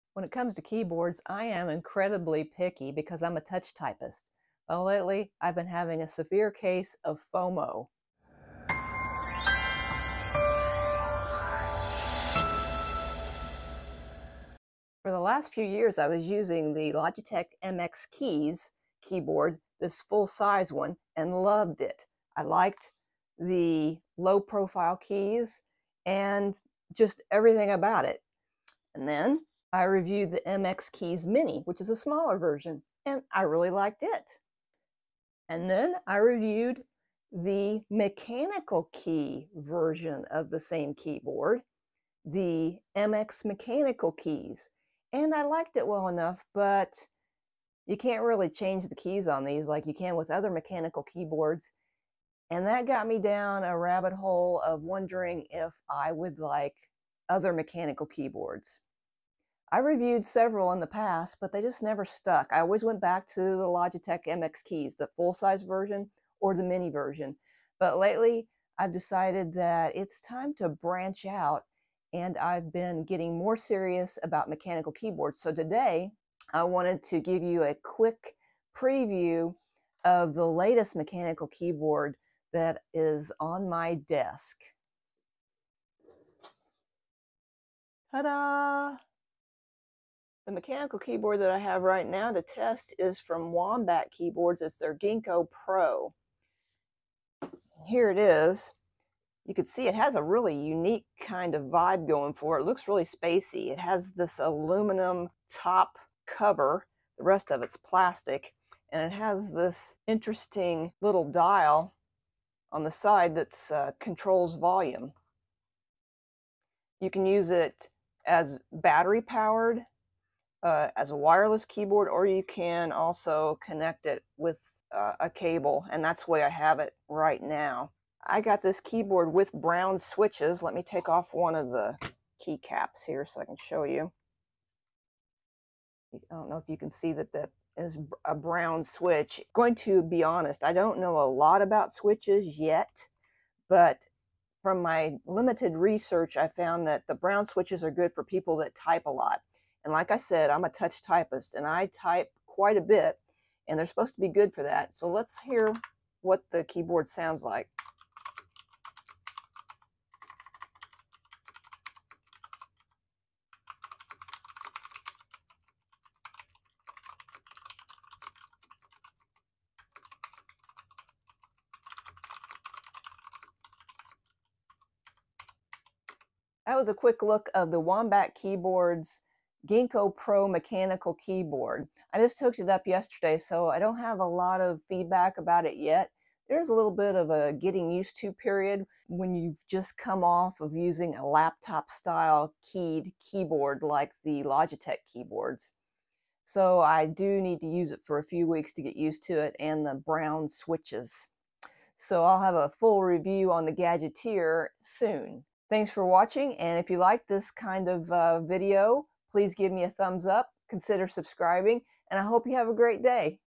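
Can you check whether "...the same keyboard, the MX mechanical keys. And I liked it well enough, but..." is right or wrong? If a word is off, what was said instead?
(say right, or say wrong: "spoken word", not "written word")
right.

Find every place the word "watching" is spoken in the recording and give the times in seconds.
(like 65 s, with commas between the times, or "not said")
206 s.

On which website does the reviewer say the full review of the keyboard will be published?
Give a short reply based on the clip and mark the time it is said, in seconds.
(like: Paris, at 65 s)
The Gadgeteer, at 203 s.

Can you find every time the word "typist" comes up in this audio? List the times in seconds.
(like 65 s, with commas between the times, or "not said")
3 s, 151 s.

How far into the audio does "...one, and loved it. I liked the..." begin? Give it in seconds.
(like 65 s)
20 s.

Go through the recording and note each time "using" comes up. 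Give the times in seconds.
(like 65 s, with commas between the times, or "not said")
16 s, 190 s.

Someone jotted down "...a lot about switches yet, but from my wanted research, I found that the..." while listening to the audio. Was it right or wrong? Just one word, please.
wrong.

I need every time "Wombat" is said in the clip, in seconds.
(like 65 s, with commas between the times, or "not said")
93 s, 177 s.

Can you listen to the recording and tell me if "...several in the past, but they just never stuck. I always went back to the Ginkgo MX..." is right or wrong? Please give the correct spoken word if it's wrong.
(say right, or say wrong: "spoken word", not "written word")
wrong: "Logitech", not "Ginkgo".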